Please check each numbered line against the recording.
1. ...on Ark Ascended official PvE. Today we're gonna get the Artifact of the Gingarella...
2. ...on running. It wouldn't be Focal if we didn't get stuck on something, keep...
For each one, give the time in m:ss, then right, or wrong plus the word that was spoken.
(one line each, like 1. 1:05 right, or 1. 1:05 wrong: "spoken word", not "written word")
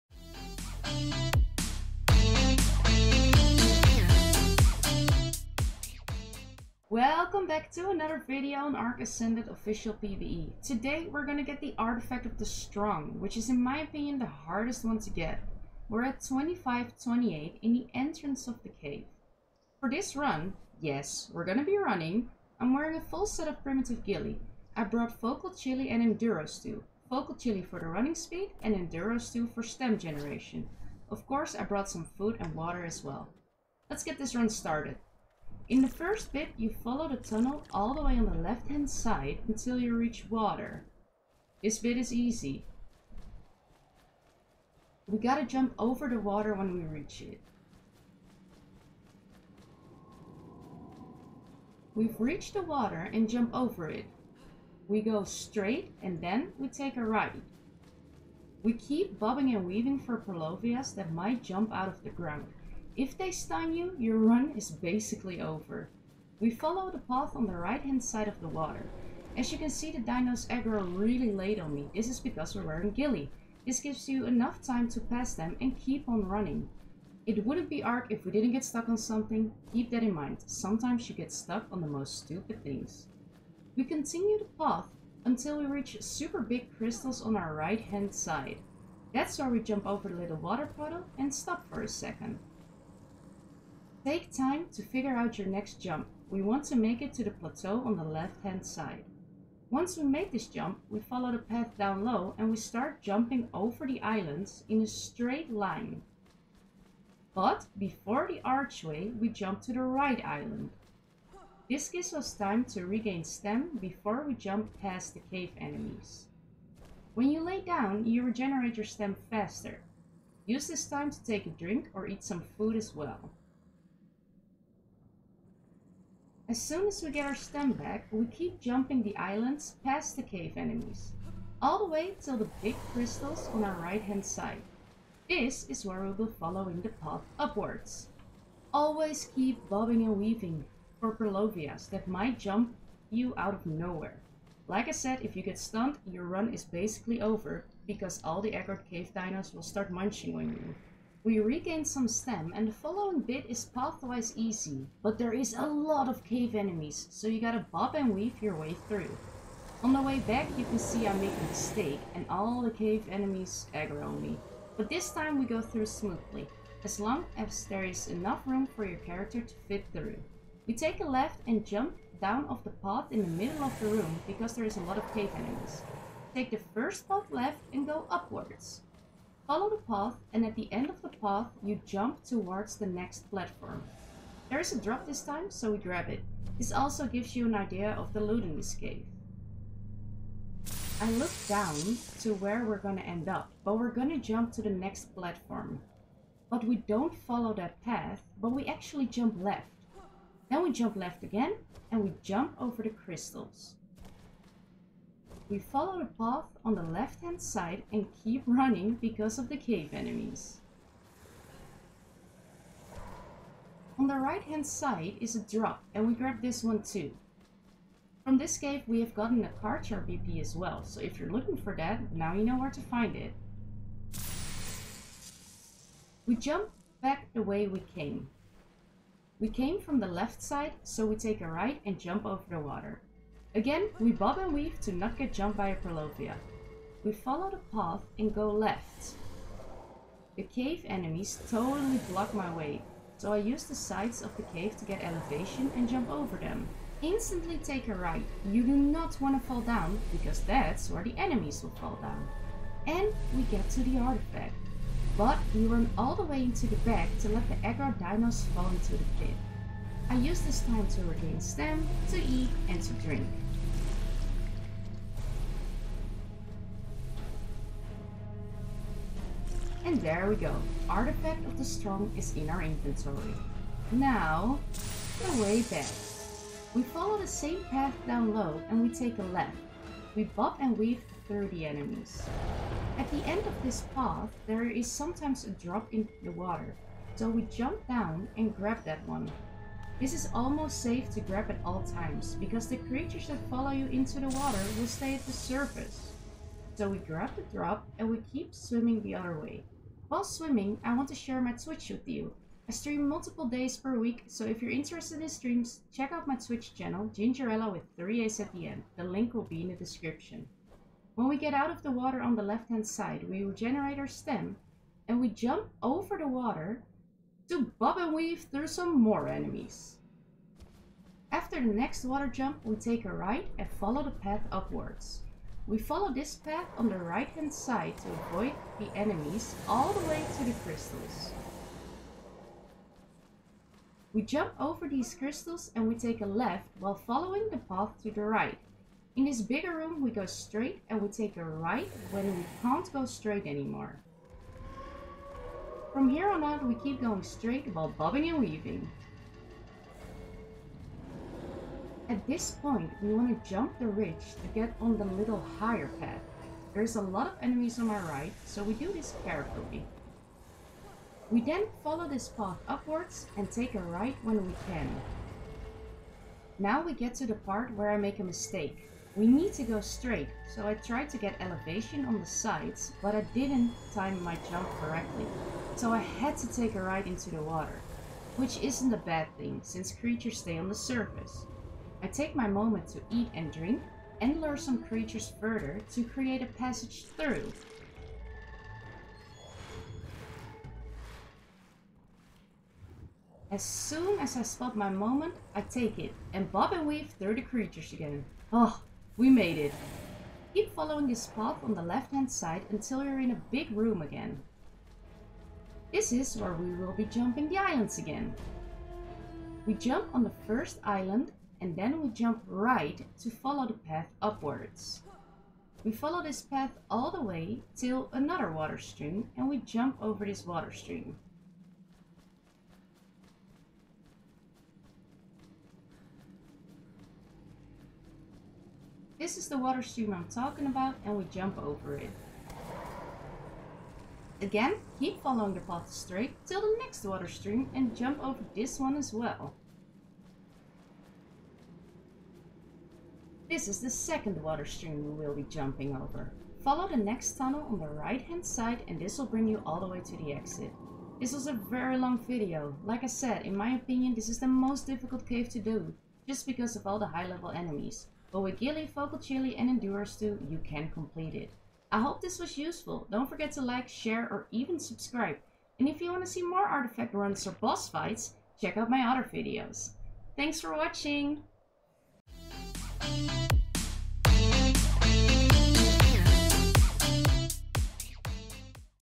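1. 0:08 wrong: "Strong", not "Gingarella"
2. 1:16 wrong: "Ark", not "Focal".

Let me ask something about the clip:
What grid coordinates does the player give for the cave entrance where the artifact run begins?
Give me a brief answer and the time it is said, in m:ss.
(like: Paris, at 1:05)
25 28, at 0:16.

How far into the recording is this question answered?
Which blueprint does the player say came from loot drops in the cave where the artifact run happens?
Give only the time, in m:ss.
3:39.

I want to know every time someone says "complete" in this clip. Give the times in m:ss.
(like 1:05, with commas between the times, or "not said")
7:40.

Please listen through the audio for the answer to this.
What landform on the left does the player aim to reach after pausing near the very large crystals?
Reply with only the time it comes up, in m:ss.
1:37.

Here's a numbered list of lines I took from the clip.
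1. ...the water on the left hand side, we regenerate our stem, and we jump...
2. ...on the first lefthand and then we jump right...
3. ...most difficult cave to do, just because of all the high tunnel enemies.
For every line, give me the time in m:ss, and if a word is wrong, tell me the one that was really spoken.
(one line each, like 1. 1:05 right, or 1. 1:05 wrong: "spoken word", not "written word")
1. 5:11 right
2. 6:50 wrong: "island", not "lefthand"
3. 7:34 wrong: "level", not "tunnel".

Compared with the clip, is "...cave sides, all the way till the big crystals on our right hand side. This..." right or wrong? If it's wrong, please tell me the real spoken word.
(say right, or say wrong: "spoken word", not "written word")
wrong: "enemies", not "sides".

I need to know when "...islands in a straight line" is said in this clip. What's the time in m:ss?
1:44.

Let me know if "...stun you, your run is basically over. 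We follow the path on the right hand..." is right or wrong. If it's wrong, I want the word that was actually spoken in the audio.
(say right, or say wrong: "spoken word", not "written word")
right.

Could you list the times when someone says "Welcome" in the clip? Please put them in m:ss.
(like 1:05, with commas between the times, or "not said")
0:06.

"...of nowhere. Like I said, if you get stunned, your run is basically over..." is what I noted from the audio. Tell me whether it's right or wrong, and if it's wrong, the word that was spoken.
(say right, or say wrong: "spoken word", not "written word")
right.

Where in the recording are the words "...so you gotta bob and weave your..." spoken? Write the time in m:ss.
2:37.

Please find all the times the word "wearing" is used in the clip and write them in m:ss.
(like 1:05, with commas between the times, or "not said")
0:22, 1:12.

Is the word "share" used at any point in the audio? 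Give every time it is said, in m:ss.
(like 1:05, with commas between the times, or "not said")
5:01, 7:43.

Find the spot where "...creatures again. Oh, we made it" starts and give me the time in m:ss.
6:37.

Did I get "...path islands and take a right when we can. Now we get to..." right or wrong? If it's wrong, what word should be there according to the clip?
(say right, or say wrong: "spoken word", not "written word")
wrong: "upwards", not "islands".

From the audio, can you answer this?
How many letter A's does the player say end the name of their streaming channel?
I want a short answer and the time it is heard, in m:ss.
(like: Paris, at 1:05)
3, at 5:07.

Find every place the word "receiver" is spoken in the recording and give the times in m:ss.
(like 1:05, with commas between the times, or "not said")
not said.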